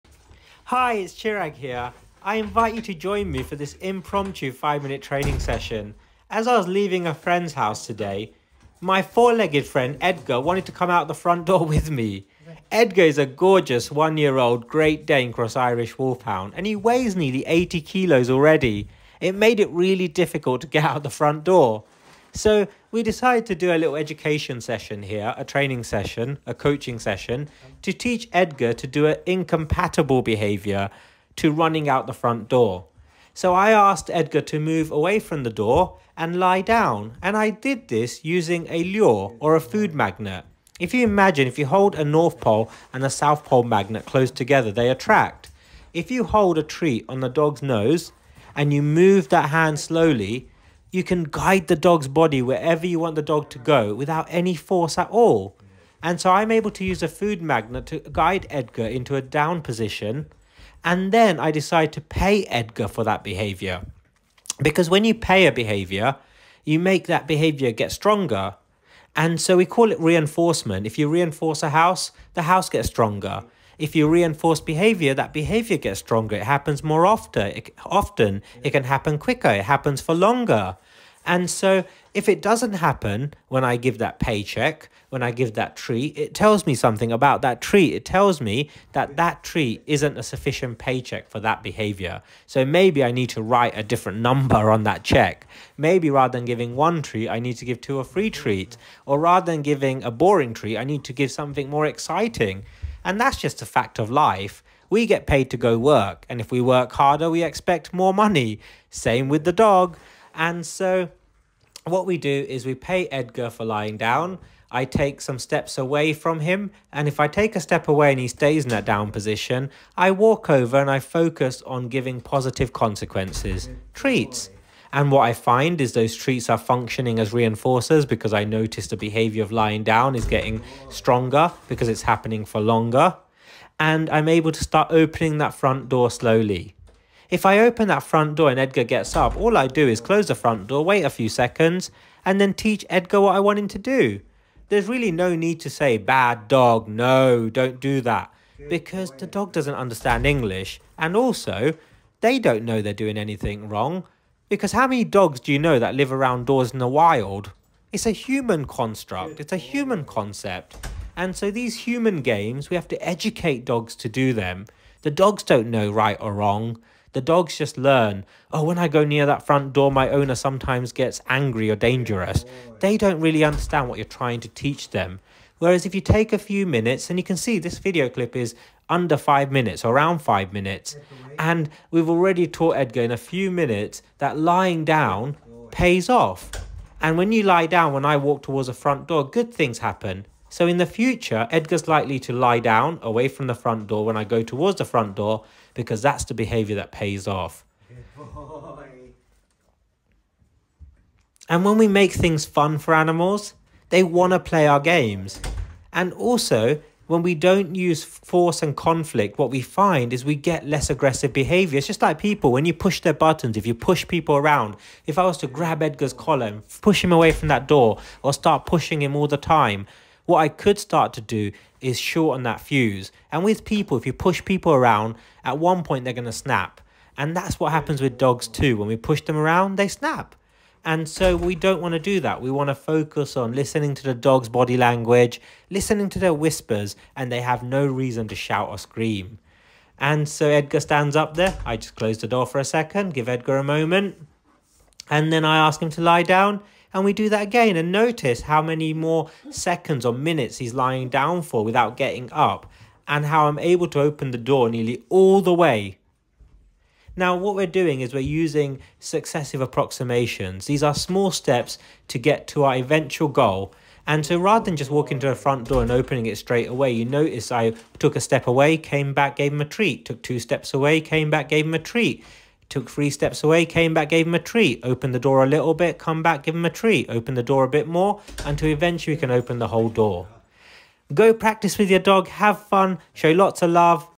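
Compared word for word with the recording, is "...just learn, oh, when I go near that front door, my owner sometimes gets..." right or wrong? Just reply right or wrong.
right.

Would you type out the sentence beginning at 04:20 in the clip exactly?
These are small steps to get to our eventual goal.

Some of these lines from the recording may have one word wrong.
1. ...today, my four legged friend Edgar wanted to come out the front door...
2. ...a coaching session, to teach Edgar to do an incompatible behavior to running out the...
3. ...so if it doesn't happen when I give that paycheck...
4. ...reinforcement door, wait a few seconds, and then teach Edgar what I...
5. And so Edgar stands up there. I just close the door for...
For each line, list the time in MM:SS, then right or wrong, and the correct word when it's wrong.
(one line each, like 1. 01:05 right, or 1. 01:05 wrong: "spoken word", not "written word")
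1. 00:07 right
2. 00:26 right
3. 01:21 right
4. 02:20 wrong: "front", not "reinforcement"
5. 03:59 right.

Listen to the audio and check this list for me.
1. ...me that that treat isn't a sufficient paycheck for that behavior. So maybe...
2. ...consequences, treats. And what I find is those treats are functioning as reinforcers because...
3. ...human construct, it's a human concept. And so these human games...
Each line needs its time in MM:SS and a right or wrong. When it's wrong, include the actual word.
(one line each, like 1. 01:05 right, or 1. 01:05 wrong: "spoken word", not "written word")
1. 01:28 right
2. 02:02 right
3. 02:38 right.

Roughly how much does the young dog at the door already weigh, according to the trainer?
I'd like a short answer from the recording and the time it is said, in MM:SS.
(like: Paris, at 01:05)
80 kilos, at 00:17.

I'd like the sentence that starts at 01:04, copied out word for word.
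Because when you pay a behavior, you make that behavior get stronger.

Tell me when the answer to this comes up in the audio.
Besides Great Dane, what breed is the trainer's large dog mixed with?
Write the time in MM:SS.
00:15.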